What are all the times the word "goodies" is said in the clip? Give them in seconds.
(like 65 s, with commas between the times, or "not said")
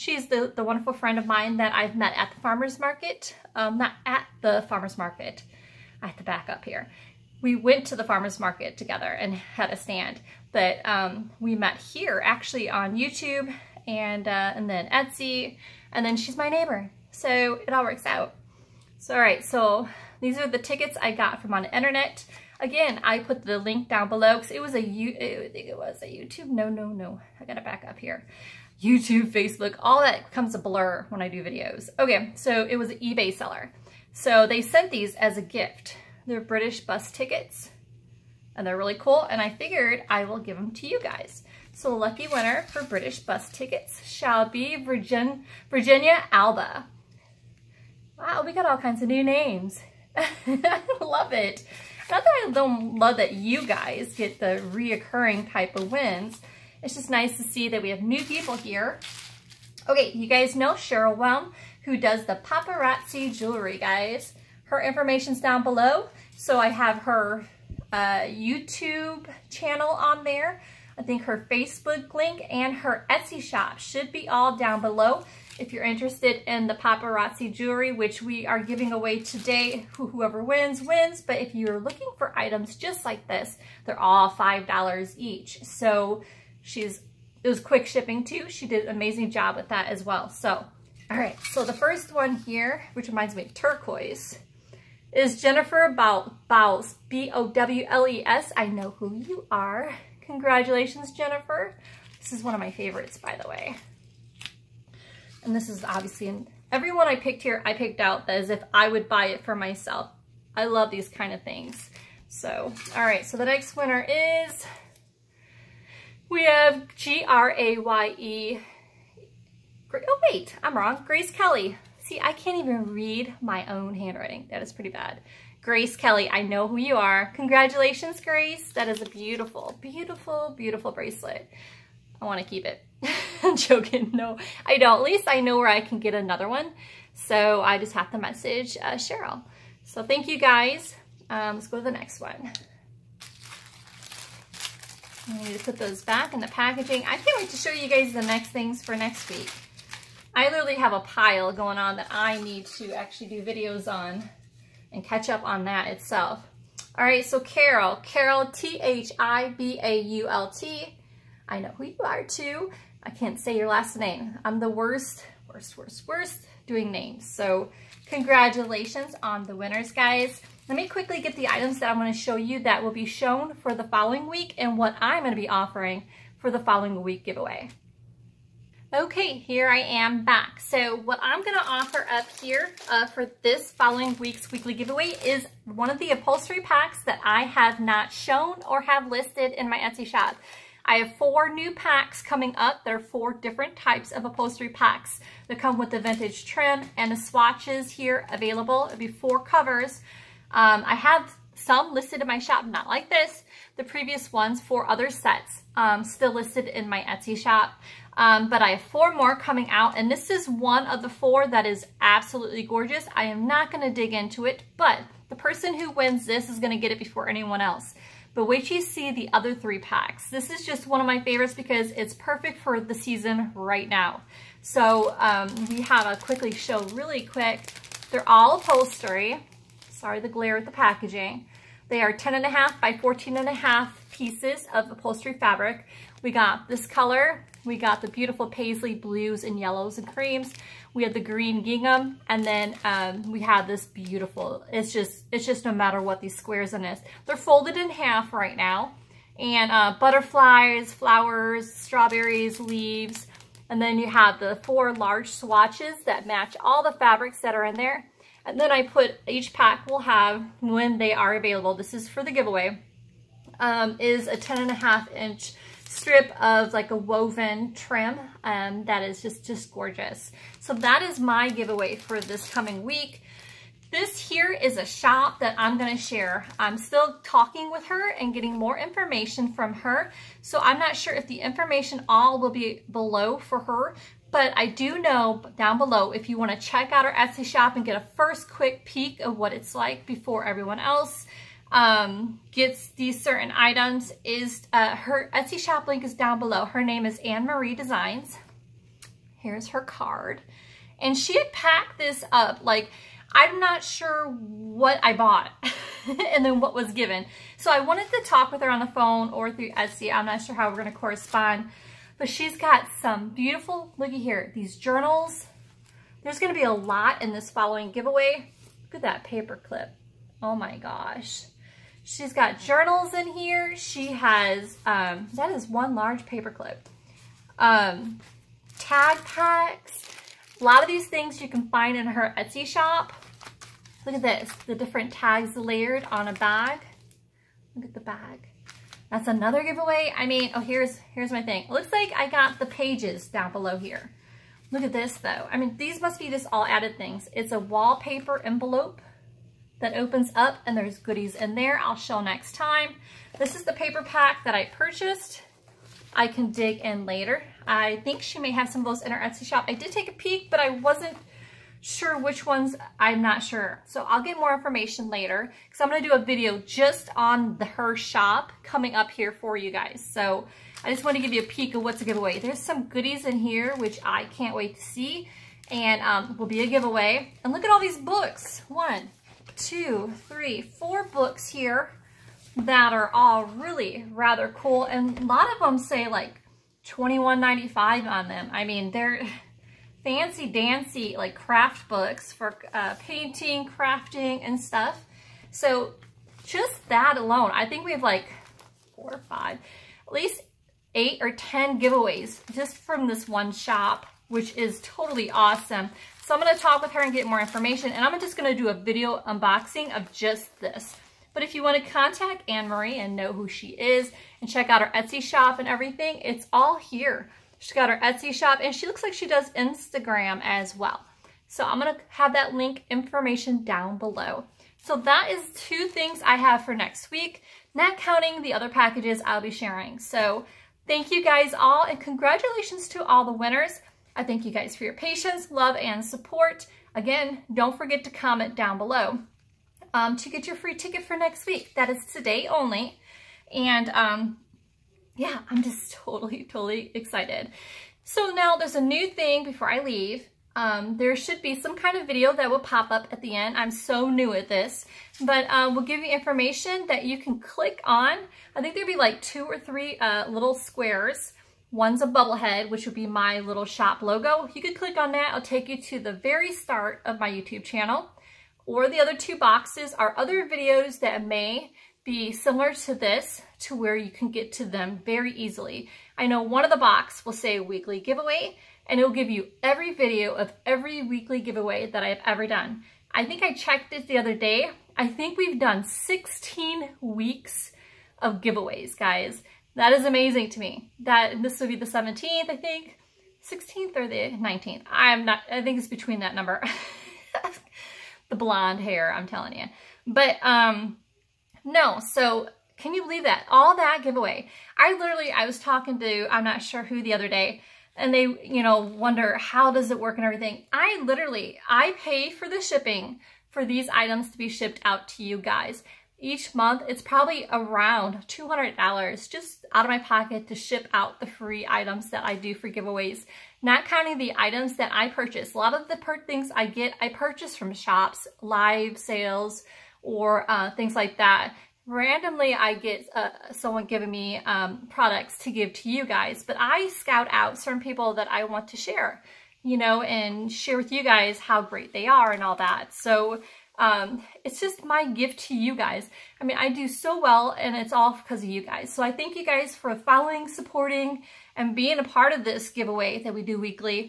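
350 s, 372 s.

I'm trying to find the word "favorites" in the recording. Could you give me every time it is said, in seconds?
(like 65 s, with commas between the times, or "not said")
102 s, 221 s.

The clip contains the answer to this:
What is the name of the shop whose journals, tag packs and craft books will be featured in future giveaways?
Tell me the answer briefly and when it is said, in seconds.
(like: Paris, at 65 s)
Anne Marie Designs, at 297 s.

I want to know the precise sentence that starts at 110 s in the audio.
I love these kind of things.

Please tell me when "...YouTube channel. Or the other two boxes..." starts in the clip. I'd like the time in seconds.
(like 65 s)
467 s.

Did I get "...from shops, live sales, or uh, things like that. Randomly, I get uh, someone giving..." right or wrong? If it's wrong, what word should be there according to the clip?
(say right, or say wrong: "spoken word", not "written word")
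right.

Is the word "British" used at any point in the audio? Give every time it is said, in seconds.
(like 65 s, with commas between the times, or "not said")
36 s, 42 s.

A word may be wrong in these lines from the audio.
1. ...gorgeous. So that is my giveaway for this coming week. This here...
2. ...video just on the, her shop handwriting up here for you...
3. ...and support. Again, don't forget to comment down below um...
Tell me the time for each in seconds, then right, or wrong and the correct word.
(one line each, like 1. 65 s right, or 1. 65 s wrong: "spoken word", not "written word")
1. 269 s right
2. 366 s wrong: "coming", not "handwriting"
3. 435 s right.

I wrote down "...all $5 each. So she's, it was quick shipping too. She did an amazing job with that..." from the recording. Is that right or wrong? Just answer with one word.
right.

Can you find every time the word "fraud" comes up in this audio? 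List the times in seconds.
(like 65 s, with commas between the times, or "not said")
not said.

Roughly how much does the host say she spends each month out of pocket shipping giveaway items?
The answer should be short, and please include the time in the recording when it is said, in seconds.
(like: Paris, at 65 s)
$200, at 518 s.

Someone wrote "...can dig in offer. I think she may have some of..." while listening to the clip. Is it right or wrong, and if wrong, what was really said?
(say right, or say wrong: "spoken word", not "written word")
wrong: "later", not "offer".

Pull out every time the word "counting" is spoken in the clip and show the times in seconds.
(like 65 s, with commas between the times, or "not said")
427 s, 523 s.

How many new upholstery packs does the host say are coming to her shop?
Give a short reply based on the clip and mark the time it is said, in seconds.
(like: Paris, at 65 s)
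4, at 191 s.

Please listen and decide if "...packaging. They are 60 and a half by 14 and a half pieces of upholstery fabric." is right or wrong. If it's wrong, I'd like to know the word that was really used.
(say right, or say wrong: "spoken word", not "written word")
wrong: "10", not "60".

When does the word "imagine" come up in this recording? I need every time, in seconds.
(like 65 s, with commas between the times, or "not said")
not said.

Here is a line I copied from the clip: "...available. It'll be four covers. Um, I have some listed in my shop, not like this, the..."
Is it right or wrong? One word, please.
right.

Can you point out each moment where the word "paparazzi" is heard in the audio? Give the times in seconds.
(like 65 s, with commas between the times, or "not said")
62 s, 76 s.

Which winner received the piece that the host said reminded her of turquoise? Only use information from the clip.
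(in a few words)
Jennifer Bowles.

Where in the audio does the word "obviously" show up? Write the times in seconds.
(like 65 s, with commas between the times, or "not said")
105 s.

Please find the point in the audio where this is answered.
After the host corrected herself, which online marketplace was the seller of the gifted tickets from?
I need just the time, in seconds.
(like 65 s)
32 s.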